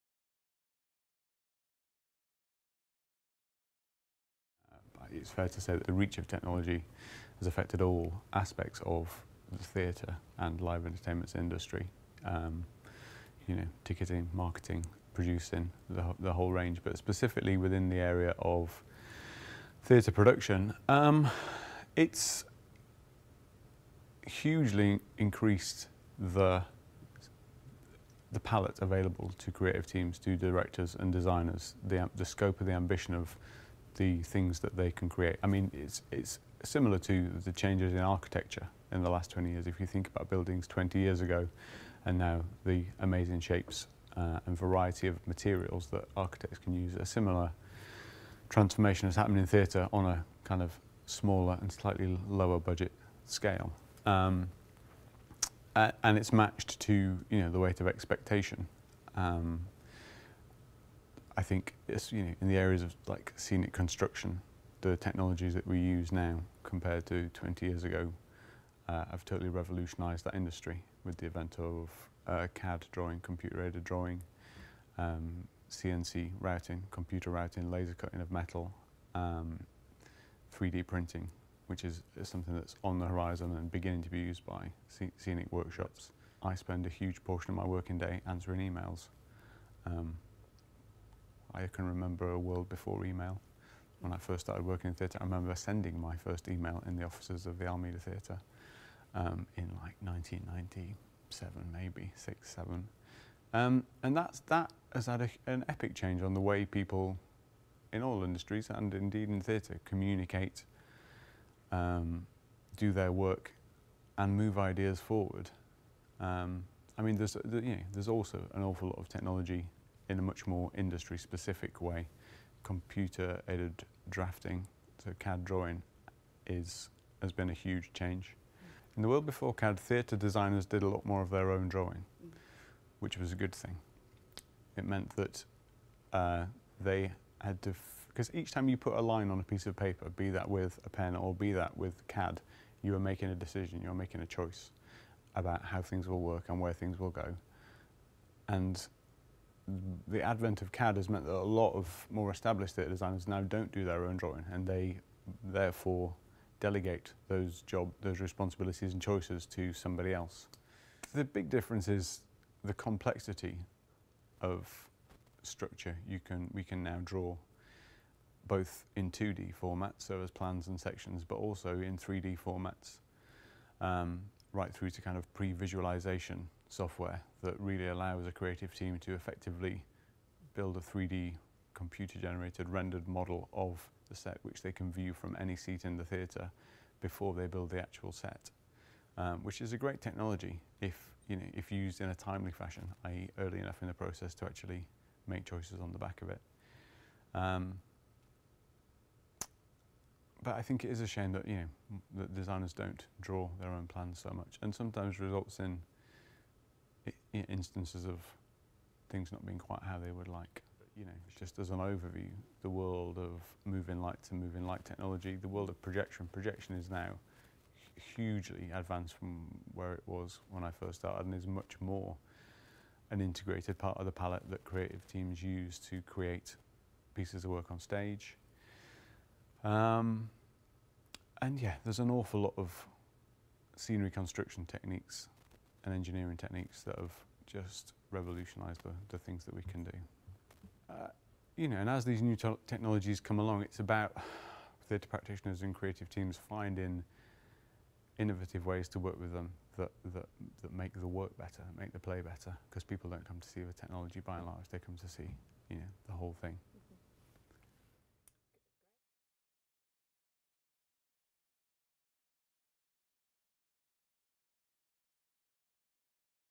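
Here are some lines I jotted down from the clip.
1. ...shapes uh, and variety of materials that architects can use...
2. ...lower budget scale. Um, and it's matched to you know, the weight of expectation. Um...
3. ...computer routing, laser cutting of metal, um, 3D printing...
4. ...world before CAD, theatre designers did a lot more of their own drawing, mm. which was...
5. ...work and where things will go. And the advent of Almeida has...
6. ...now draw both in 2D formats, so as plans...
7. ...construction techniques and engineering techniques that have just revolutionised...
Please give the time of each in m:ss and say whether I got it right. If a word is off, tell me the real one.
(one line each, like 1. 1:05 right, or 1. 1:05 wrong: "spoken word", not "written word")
1. 0:43 right
2. 0:52 right
3. 1:16 right
4. 2:09 right
5. 2:26 wrong: "CAD", not "Almeida"
6. 2:46 right
7. 3:54 right.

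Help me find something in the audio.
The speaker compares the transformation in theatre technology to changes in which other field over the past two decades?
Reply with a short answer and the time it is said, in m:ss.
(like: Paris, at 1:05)
Architecture, at 0:37.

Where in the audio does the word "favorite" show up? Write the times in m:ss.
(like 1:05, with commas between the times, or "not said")
not said.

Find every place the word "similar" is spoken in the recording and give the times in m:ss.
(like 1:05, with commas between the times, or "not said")
0:36, 0:47.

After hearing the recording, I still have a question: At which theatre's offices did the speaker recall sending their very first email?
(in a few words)
Almeida Theatre.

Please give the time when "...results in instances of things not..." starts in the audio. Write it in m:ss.
3:25.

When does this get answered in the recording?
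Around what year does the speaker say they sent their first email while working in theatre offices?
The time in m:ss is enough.
1:40.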